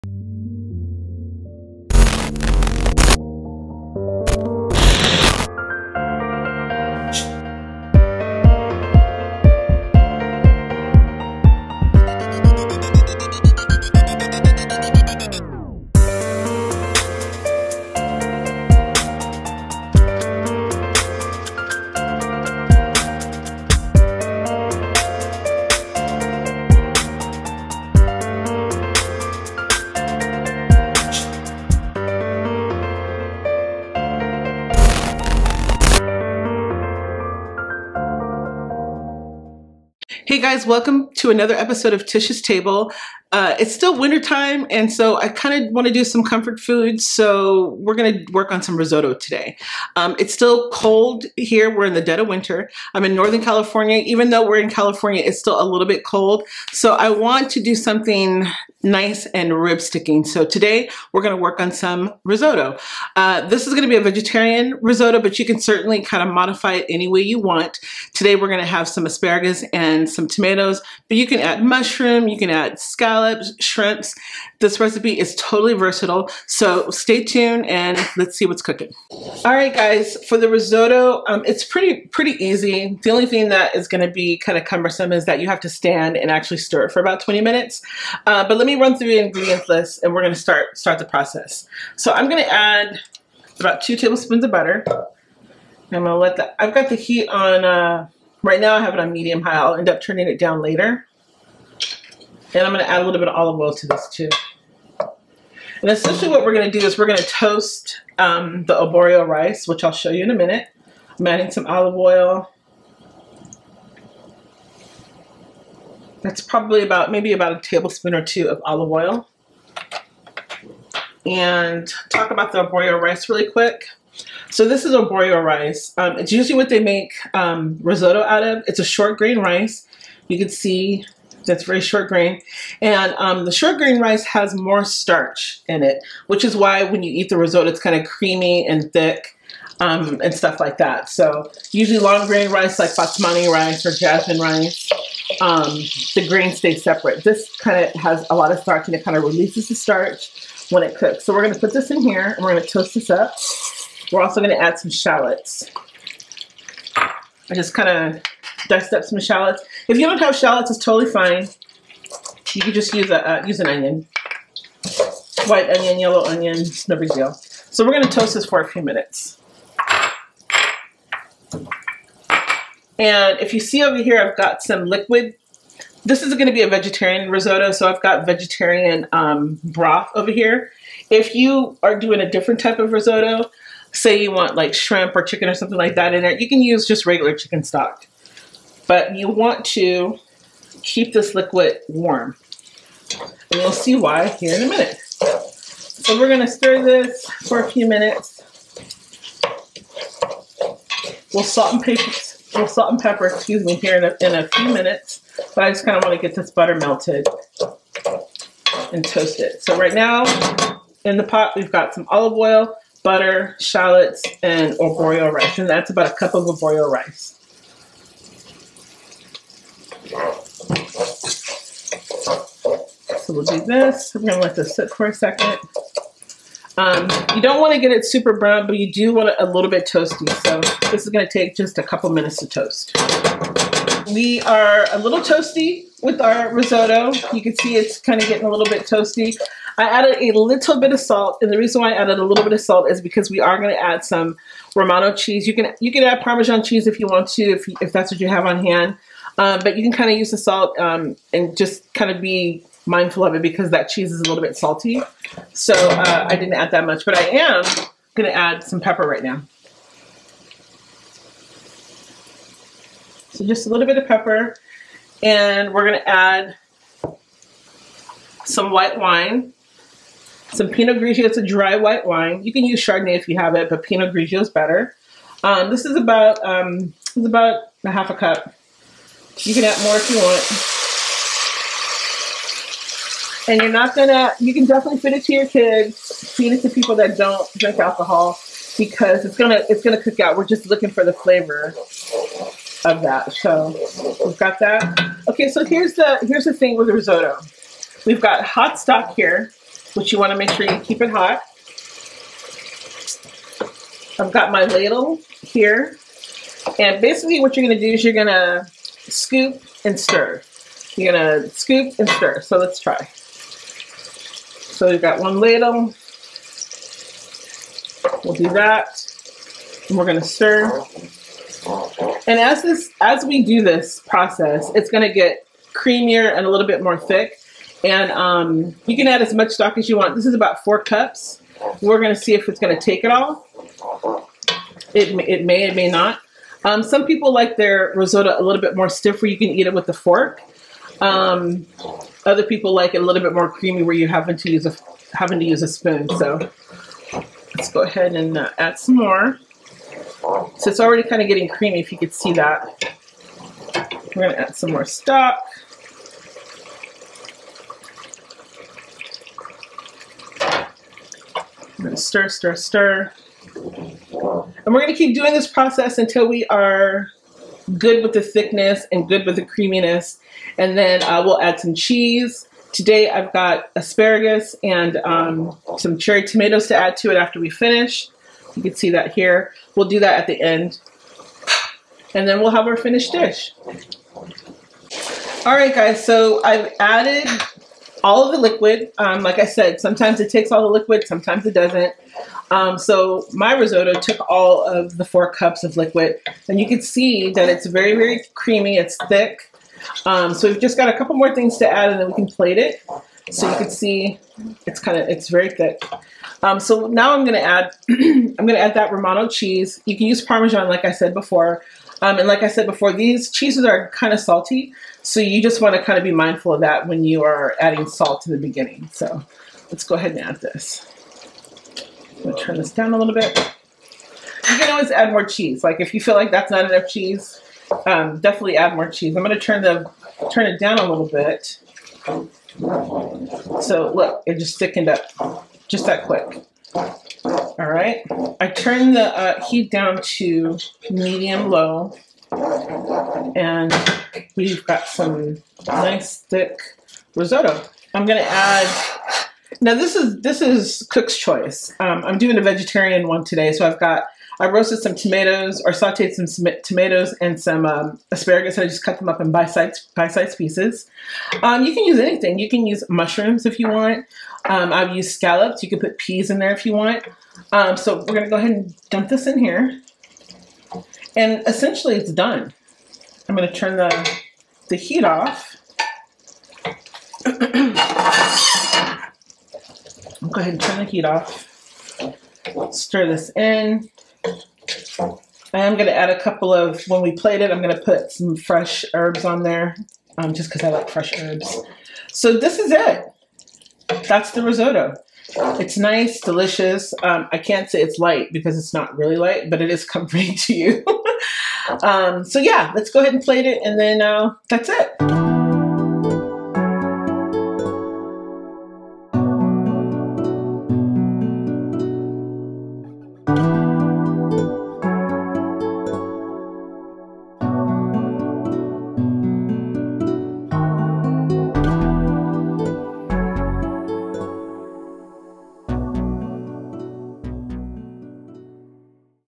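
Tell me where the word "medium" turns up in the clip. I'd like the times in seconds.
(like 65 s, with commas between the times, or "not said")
99 s, 440 s.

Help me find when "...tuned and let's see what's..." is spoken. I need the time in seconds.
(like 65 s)
77 s.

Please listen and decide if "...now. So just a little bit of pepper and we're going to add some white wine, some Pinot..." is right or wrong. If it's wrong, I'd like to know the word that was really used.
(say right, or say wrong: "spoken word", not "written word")
right.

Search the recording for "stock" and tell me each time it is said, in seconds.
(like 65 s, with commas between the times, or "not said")
187 s, 298 s, 329 s, 354 s.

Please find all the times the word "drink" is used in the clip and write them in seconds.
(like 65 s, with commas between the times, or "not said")
287 s.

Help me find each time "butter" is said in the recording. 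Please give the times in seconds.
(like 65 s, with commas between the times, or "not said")
94 s, 206 s, 213 s.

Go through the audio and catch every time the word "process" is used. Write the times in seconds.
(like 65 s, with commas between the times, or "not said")
91 s, 324 s, 365 s.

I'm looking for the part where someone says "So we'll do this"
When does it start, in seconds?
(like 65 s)
223 s.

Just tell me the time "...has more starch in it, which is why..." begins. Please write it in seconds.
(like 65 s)
134 s.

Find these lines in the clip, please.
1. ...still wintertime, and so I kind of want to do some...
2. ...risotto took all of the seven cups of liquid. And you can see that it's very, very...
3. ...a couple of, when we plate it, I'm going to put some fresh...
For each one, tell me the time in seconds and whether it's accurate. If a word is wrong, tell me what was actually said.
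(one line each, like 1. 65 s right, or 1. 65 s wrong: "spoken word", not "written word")
1. 43 s right
2. 393 s wrong: "four", not "seven"
3. 486 s right.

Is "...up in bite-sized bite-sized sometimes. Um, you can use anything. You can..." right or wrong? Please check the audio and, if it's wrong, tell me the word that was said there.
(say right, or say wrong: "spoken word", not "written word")
wrong: "pieces", not "sometimes".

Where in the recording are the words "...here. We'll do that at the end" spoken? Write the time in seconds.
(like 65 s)
379 s.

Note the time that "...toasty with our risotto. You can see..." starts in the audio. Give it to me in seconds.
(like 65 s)
235 s.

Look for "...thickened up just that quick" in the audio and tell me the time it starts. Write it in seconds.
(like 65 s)
434 s.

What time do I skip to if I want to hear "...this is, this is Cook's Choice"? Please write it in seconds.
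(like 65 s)
449 s.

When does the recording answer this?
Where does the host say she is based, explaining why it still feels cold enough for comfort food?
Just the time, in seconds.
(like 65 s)
53 s.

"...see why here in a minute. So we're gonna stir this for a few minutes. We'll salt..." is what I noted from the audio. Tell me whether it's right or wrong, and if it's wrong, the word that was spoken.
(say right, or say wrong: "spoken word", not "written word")
right.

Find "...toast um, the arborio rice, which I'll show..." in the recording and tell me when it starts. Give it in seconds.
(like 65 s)
107 s.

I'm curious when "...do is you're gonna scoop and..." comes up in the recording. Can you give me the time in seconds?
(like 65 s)
307 s.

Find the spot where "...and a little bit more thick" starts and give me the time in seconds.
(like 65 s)
326 s.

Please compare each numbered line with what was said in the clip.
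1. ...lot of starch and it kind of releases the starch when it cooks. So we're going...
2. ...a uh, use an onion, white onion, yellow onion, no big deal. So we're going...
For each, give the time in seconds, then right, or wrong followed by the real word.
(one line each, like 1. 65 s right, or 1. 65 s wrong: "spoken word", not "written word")
1. 148 s right
2. 163 s right.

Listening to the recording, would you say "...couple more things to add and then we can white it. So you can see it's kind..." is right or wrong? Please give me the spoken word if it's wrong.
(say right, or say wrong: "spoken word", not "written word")
wrong: "plate", not "white".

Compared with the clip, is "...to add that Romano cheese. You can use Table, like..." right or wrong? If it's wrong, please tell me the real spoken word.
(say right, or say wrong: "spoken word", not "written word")
wrong: "Parmesan", not "Table".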